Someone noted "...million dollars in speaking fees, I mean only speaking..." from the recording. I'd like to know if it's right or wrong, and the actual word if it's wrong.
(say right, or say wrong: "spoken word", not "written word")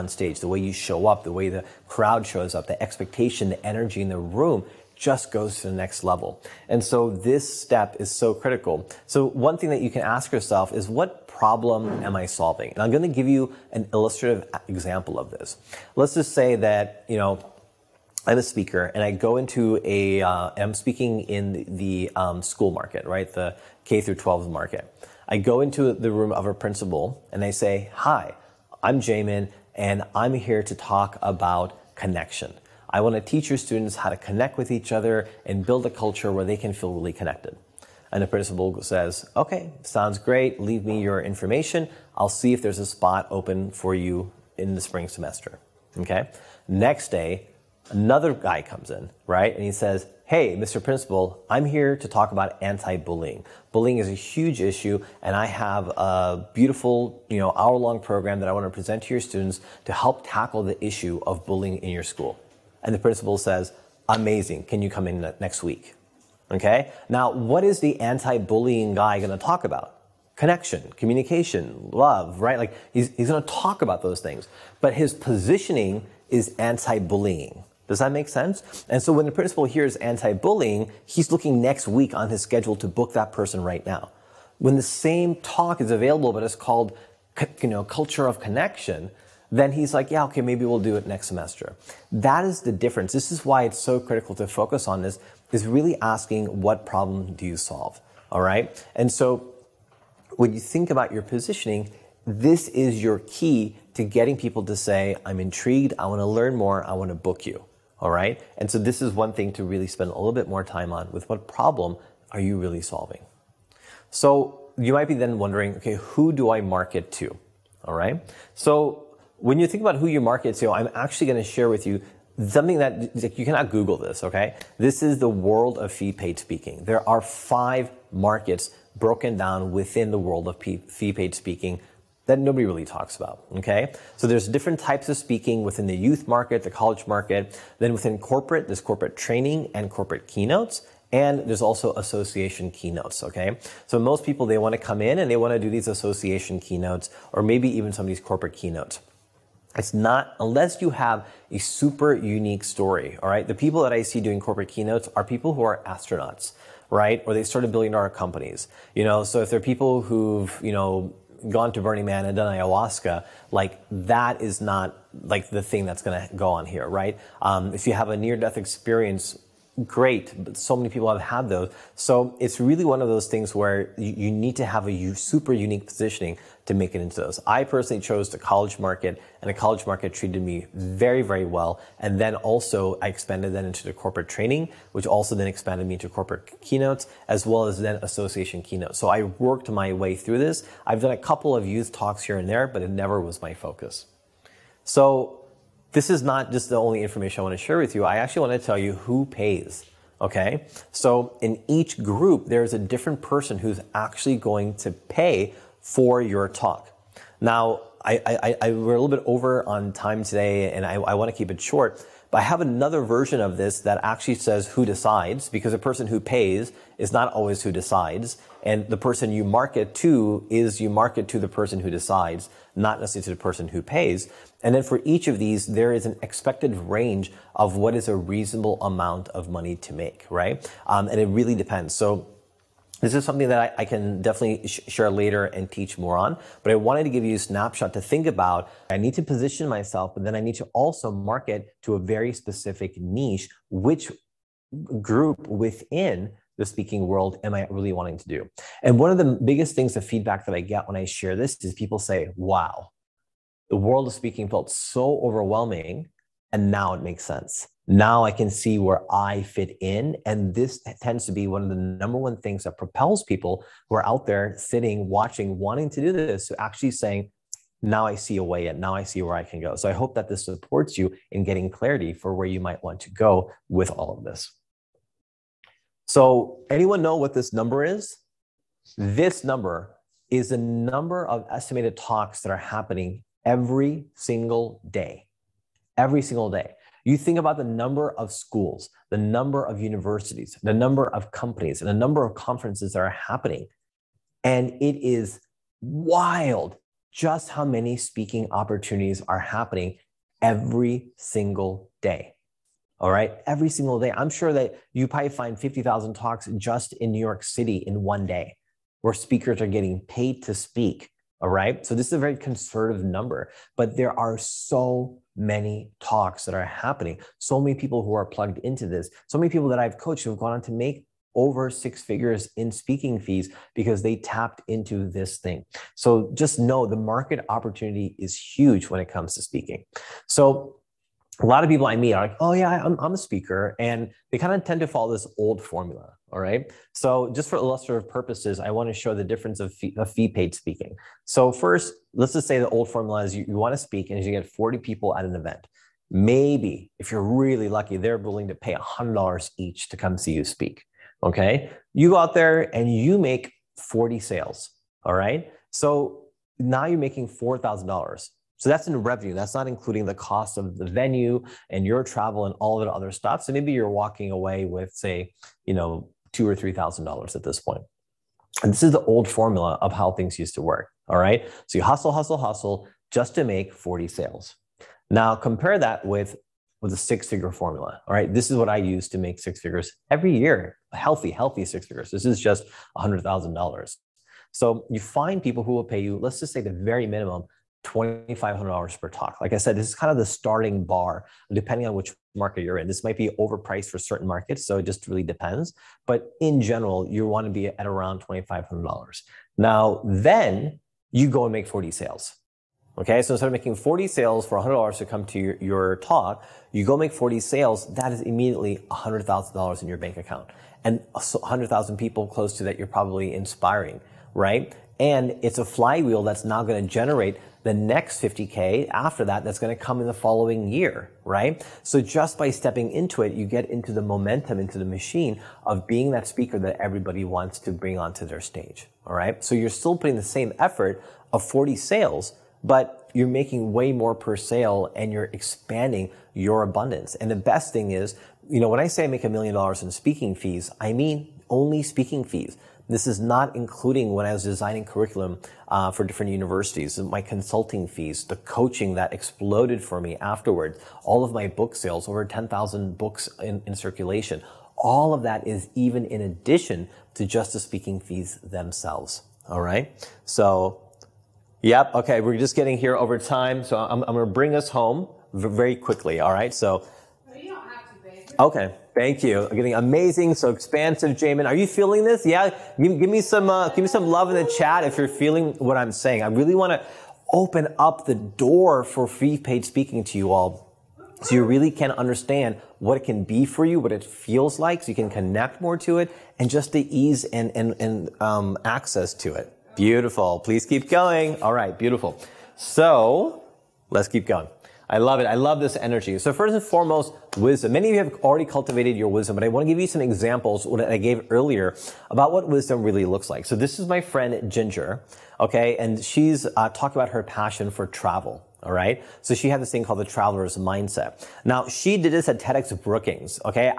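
right.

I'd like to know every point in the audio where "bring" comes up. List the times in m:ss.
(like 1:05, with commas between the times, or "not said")
7:07, 7:44.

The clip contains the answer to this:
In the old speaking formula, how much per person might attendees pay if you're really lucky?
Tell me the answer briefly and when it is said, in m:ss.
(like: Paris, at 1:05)
$100, at 5:48.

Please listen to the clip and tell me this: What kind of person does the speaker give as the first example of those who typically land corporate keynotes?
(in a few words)
astronauts.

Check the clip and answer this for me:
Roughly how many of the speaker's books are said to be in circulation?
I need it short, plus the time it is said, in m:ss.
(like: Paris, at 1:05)
over 10,000, at 7:32.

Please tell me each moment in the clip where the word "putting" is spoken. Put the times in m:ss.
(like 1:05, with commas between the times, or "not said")
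7:09.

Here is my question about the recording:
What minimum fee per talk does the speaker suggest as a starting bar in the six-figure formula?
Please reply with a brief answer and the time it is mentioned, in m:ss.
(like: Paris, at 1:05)
$2,500, at 6:27.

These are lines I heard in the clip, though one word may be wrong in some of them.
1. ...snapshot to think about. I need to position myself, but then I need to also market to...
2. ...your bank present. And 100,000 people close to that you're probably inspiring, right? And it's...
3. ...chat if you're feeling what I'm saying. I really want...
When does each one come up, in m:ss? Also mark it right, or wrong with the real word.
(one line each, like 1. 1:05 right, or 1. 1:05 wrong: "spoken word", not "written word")
1. 3:57 right
2. 6:49 wrong: "account", not "present"
3. 7:54 right.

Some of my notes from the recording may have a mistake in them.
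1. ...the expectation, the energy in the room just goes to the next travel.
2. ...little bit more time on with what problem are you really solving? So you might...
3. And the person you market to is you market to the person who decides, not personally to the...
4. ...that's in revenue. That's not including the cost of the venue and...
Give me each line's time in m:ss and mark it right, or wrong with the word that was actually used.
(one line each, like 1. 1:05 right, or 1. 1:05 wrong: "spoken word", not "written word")
1. 0:02 wrong: "level", not "travel"
2. 1:50 right
3. 3:38 wrong: "necessarily", not "personally"
4. 5:58 right.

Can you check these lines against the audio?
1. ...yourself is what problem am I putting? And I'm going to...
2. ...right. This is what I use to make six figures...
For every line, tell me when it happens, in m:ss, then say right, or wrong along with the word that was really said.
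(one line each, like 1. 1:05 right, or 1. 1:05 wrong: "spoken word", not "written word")
1. 0:10 wrong: "solving", not "putting"
2. 6:18 right.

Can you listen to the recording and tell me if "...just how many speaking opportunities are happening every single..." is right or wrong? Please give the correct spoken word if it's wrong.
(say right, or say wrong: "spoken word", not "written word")
right.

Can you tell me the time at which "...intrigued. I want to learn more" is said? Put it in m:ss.
1:45.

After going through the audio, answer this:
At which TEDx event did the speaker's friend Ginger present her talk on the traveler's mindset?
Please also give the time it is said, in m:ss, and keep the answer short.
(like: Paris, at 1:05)
TEDx Brookings, at 8:32.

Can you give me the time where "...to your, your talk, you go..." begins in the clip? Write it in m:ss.
6:45.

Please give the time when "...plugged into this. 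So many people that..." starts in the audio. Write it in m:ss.
5:18.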